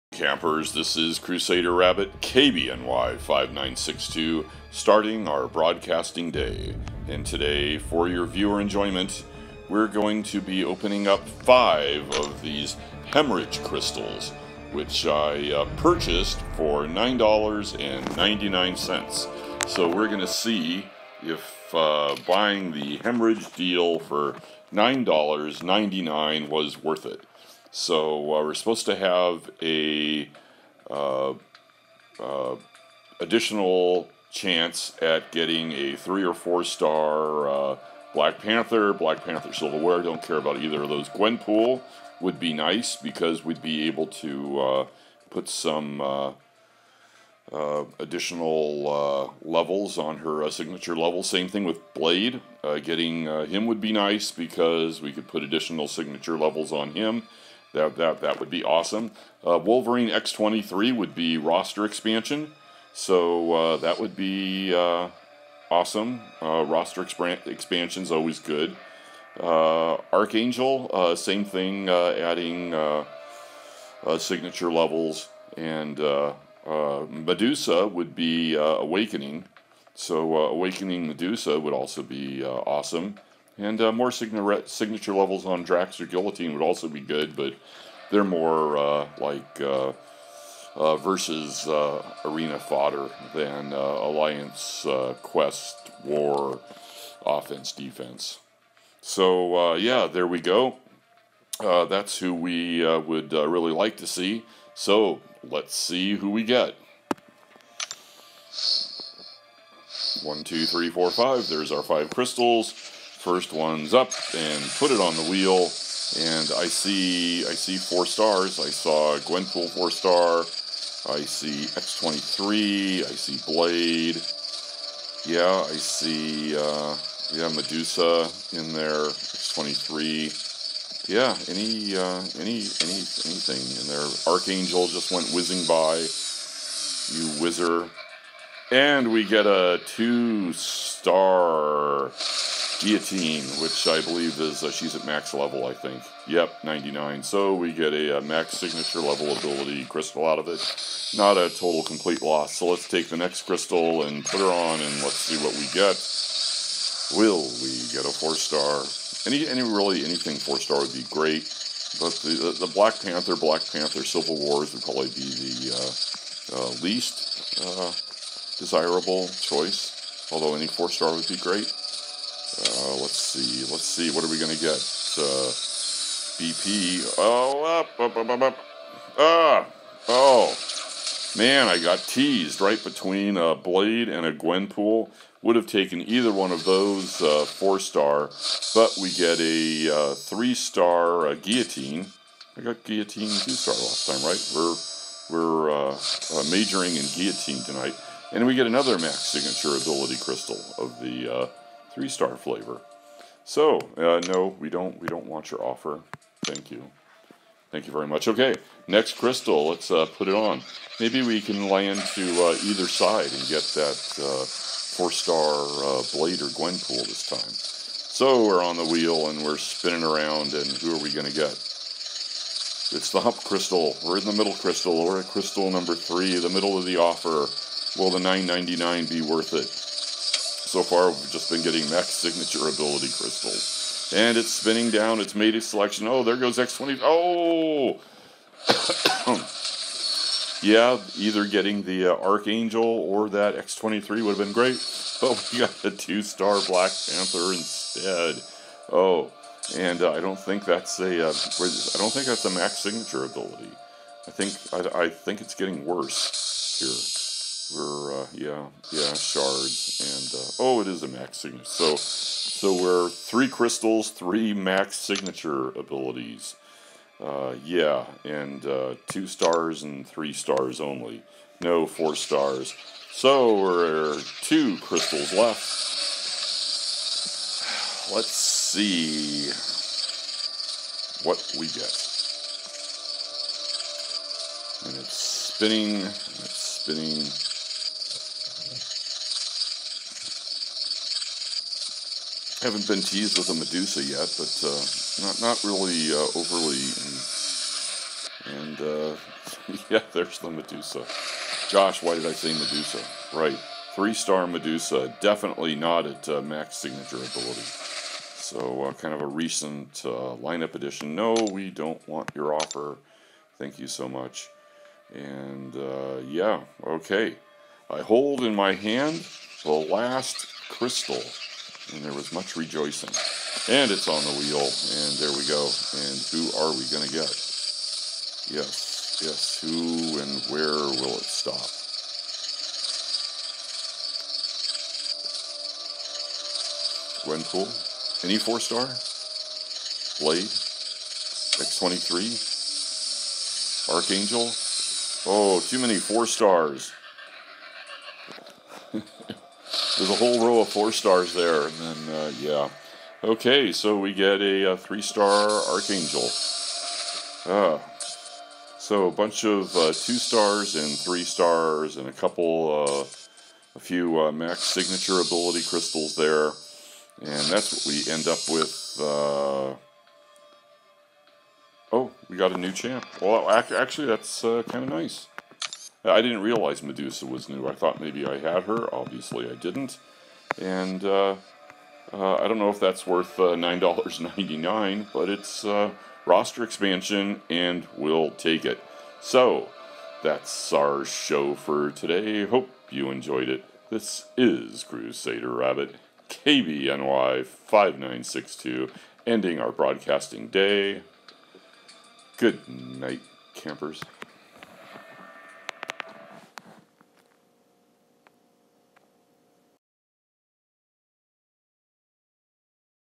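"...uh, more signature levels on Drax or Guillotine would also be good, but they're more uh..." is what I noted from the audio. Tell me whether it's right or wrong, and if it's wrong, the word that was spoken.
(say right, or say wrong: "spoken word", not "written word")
right.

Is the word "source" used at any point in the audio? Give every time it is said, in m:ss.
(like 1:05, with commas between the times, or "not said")
not said.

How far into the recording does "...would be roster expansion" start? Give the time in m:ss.
1:00.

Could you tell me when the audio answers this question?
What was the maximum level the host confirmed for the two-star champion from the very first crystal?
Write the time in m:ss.
2:26.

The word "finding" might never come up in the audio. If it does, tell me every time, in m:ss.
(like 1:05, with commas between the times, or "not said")
not said.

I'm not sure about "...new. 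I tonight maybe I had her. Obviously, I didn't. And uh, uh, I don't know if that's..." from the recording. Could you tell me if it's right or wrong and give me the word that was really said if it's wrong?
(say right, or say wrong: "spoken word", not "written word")
wrong: "thought", not "tonight".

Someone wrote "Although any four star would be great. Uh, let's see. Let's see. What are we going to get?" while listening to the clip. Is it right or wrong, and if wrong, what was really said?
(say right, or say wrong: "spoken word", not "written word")
right.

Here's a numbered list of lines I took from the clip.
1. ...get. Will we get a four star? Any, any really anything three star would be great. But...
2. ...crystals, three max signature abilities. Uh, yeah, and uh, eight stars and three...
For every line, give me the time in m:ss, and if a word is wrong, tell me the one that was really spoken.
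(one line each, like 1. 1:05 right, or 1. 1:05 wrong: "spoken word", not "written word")
1. 2:35 wrong: "four", not "three"
2. 4:23 wrong: "two", not "eight".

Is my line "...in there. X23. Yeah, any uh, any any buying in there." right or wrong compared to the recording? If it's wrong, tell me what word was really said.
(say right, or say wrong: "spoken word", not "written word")
wrong: "anything", not "buying".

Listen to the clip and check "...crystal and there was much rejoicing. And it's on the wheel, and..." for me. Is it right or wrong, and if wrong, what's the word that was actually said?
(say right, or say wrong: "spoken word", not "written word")
right.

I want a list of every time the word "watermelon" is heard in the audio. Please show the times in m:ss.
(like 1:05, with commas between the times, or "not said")
not said.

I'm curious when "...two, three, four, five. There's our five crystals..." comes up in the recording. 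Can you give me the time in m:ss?
1:50.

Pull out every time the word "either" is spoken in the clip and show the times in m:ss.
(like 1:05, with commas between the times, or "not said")
0:40, 3:06, 3:32, 4:01.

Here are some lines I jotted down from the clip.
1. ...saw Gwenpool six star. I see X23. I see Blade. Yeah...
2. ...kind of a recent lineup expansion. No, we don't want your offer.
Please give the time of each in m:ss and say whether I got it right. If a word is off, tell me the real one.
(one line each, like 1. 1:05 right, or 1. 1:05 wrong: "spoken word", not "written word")
1. 1:58 wrong: "four", not "six"
2. 5:08 wrong: "addition", not "expansion".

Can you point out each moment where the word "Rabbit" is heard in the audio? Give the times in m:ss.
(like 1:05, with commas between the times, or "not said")
0:01, 6:35.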